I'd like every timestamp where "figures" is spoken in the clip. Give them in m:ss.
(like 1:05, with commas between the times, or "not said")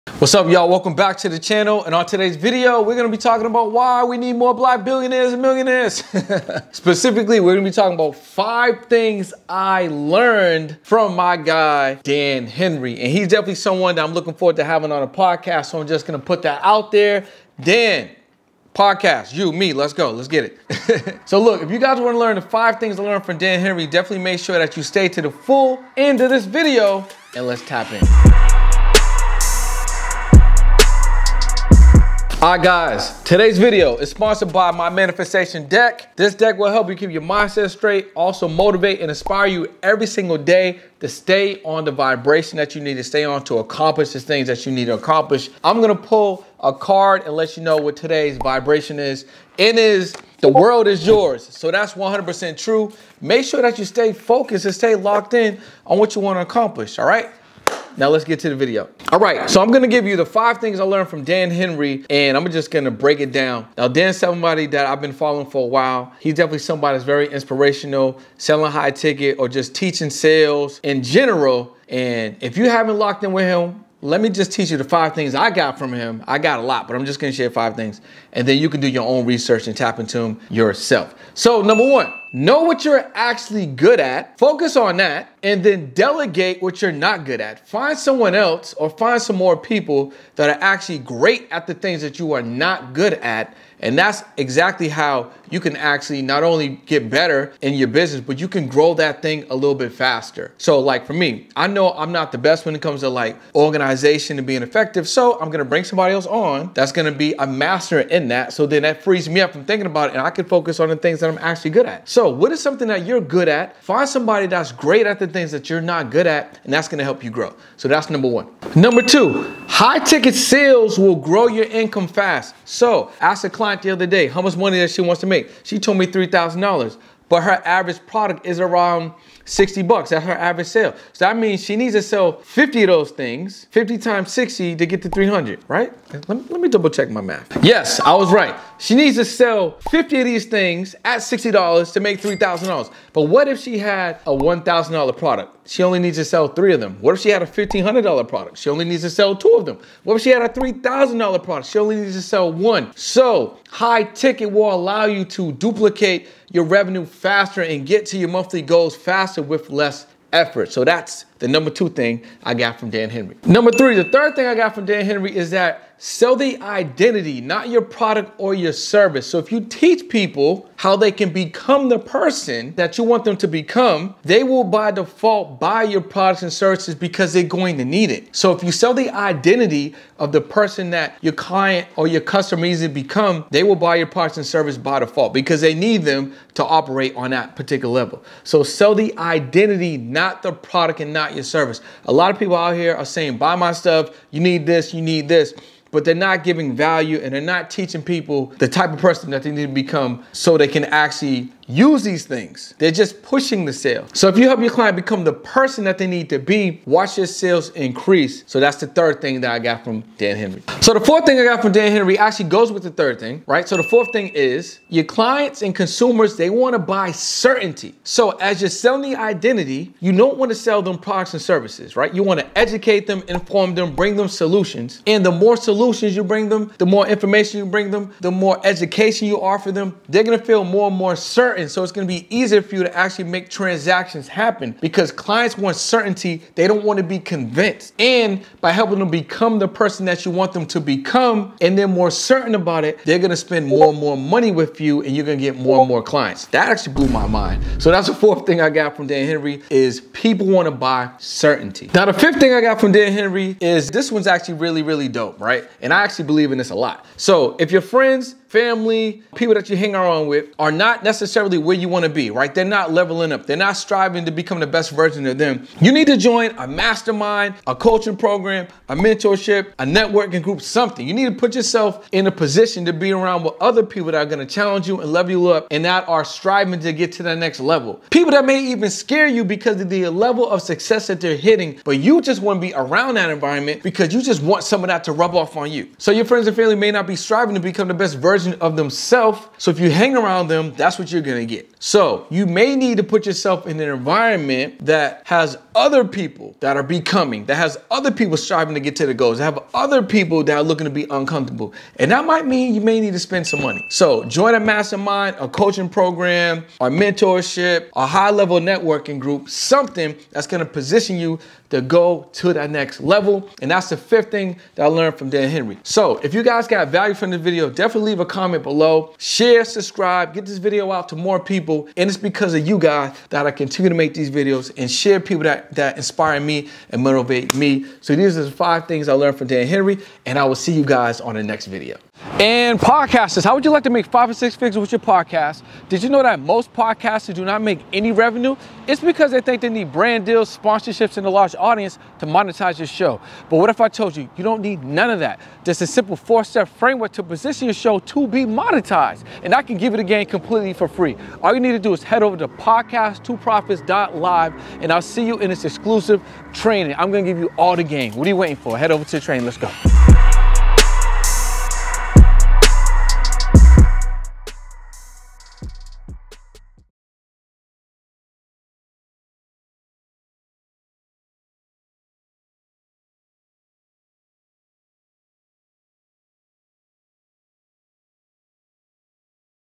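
5:34.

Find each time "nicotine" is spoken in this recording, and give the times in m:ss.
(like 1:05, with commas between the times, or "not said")
not said.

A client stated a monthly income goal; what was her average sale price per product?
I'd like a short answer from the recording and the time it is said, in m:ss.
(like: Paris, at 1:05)
$60, at 2:09.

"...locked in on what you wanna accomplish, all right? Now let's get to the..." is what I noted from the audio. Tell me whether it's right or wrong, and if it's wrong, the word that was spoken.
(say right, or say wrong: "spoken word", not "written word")
right.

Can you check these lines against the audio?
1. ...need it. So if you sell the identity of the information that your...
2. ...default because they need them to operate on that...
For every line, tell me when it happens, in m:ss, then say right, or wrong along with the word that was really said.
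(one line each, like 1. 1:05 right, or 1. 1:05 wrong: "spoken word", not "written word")
1. 2:57 wrong: "person", not "information"
2. 3:05 right.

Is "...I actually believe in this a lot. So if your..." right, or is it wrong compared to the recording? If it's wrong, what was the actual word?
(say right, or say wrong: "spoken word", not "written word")
right.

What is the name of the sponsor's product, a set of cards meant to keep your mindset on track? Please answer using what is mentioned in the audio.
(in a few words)
My Manifestation Deck.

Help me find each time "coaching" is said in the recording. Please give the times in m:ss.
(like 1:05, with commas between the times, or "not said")
4:27, 5:05.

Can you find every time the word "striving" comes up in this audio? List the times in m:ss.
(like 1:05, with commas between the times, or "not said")
4:23, 4:36, 4:47, 4:58.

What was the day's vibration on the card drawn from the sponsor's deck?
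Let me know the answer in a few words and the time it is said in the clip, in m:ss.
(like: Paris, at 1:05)
The world is yours, at 0:50.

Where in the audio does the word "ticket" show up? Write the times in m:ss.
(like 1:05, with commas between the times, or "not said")
1:08, 1:59, 2:34.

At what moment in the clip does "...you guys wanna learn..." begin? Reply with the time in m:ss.
0:21.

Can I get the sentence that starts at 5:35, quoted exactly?
Did you know that most podcasters do not make any revenue?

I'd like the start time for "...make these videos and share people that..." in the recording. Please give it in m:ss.
5:23.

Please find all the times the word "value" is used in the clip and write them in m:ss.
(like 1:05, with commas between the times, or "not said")
3:16, 5:16.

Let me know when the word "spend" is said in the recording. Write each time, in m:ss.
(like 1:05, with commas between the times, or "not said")
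4:03, 5:03.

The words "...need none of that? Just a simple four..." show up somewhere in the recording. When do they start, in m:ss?
5:44.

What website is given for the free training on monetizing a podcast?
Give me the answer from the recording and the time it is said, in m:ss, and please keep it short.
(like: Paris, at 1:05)
podcast2profits.live, at 5:52.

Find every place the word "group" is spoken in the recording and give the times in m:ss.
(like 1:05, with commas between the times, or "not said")
4:30, 5:09.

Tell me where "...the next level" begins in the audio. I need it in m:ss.
4:37.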